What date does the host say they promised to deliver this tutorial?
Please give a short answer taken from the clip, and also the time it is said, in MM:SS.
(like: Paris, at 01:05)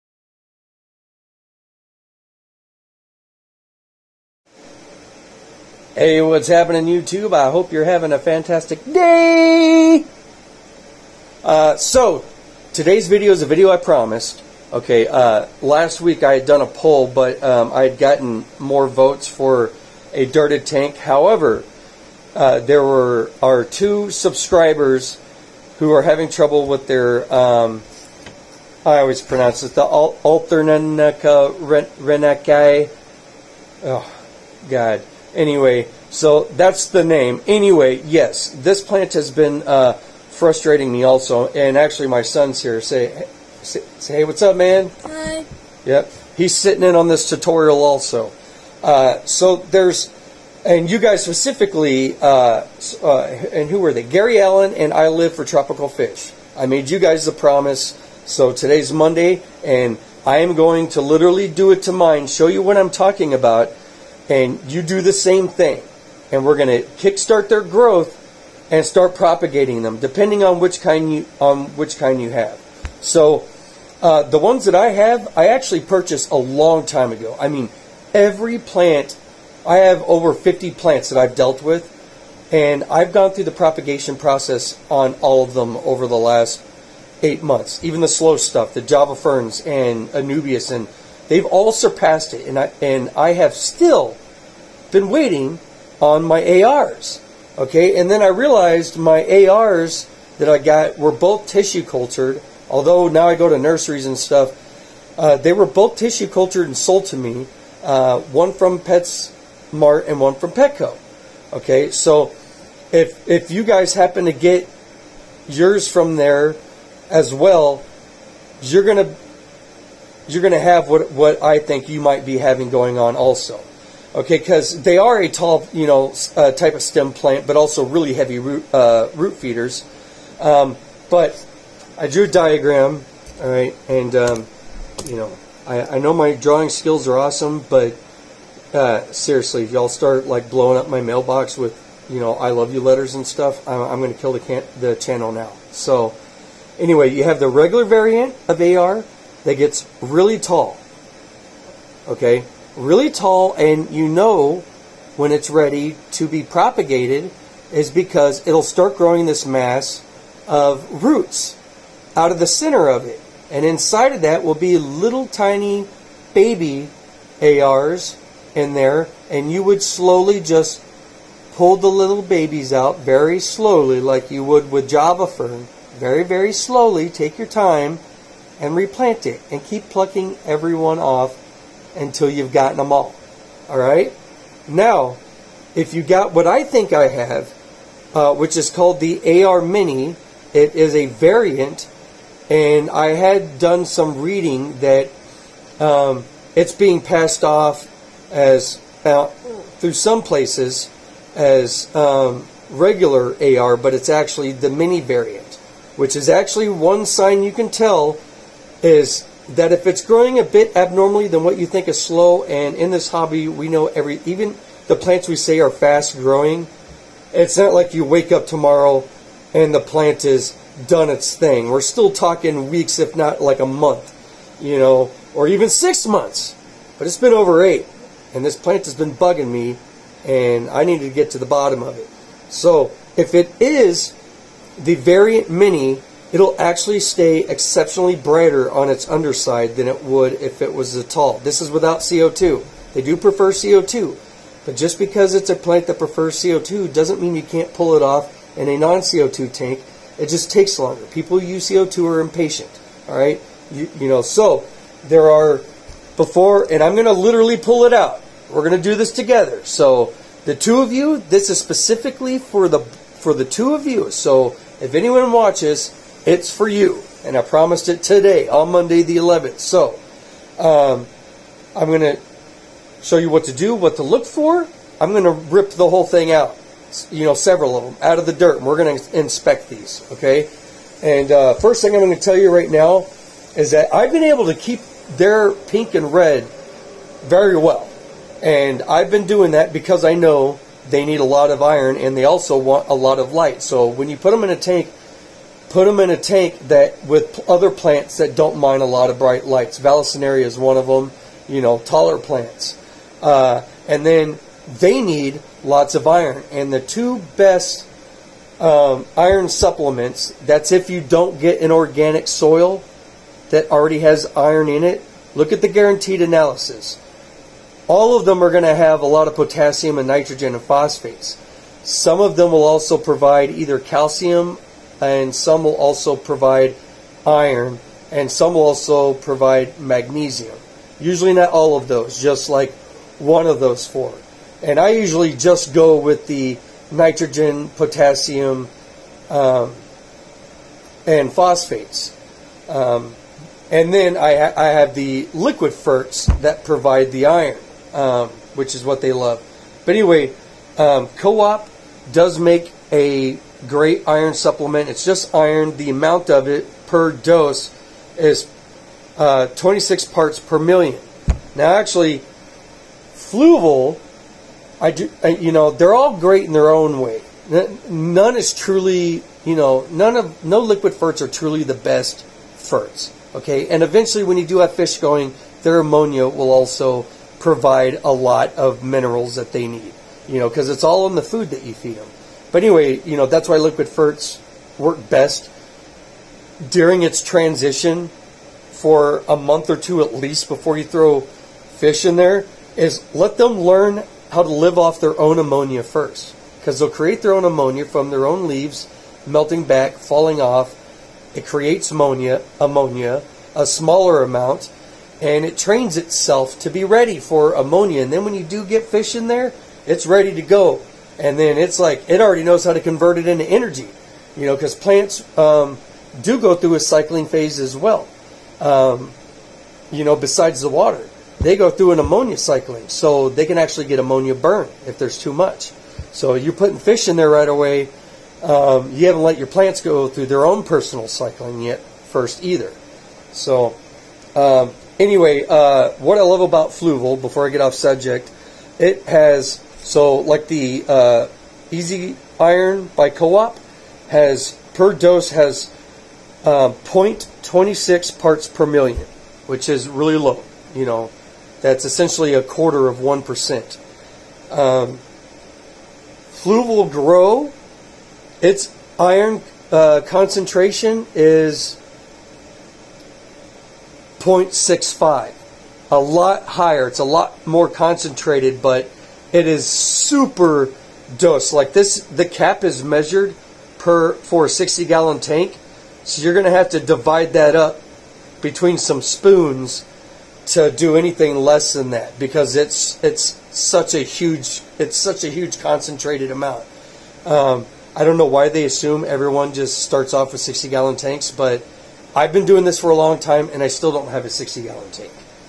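Monday the 11th, at 04:28.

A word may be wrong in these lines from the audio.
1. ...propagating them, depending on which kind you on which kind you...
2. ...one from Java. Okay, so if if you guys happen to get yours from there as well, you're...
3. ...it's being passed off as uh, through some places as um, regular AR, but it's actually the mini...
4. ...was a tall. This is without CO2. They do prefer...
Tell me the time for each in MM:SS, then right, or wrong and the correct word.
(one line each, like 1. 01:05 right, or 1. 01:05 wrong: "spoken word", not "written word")
1. 01:09 right
2. 01:50 wrong: "Petco", not "Java"
3. 03:16 right
4. 04:00 right.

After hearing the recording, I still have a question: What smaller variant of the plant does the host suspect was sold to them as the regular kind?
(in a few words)
AR Mini.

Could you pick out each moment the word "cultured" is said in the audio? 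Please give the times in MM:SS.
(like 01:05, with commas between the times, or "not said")
01:41, 01:46.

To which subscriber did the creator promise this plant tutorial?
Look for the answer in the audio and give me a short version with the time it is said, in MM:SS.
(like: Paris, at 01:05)
Gary Allen, at 00:54.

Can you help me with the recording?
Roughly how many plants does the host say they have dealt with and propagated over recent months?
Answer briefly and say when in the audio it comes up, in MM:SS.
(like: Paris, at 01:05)
over 50, at 01:20.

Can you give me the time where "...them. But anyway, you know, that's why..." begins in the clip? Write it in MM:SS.
06:21.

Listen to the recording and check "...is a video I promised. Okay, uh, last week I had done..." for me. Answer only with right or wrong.
right.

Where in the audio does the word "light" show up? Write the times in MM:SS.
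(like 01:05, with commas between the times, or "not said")
04:53, 04:59.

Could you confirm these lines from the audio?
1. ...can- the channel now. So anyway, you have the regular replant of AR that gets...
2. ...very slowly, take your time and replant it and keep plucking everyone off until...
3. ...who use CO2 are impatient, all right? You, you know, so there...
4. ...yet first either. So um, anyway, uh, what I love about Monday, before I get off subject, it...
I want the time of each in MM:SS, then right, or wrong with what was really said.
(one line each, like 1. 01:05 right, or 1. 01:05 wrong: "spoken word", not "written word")
1. 02:24 wrong: "variant", not "replant"
2. 02:56 right
3. 04:11 right
4. 07:11 wrong: "Fluval", not "Monday".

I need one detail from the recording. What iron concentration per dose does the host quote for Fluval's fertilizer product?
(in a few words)
0.65.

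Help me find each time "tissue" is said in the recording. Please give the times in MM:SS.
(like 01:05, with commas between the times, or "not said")
01:41, 01:45.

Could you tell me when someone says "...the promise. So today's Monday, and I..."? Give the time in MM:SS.
00:57.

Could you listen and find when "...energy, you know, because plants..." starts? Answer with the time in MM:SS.
06:53.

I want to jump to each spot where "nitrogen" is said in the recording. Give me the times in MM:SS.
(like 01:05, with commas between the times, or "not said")
05:20, 05:36.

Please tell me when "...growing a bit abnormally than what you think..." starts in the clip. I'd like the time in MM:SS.
03:30.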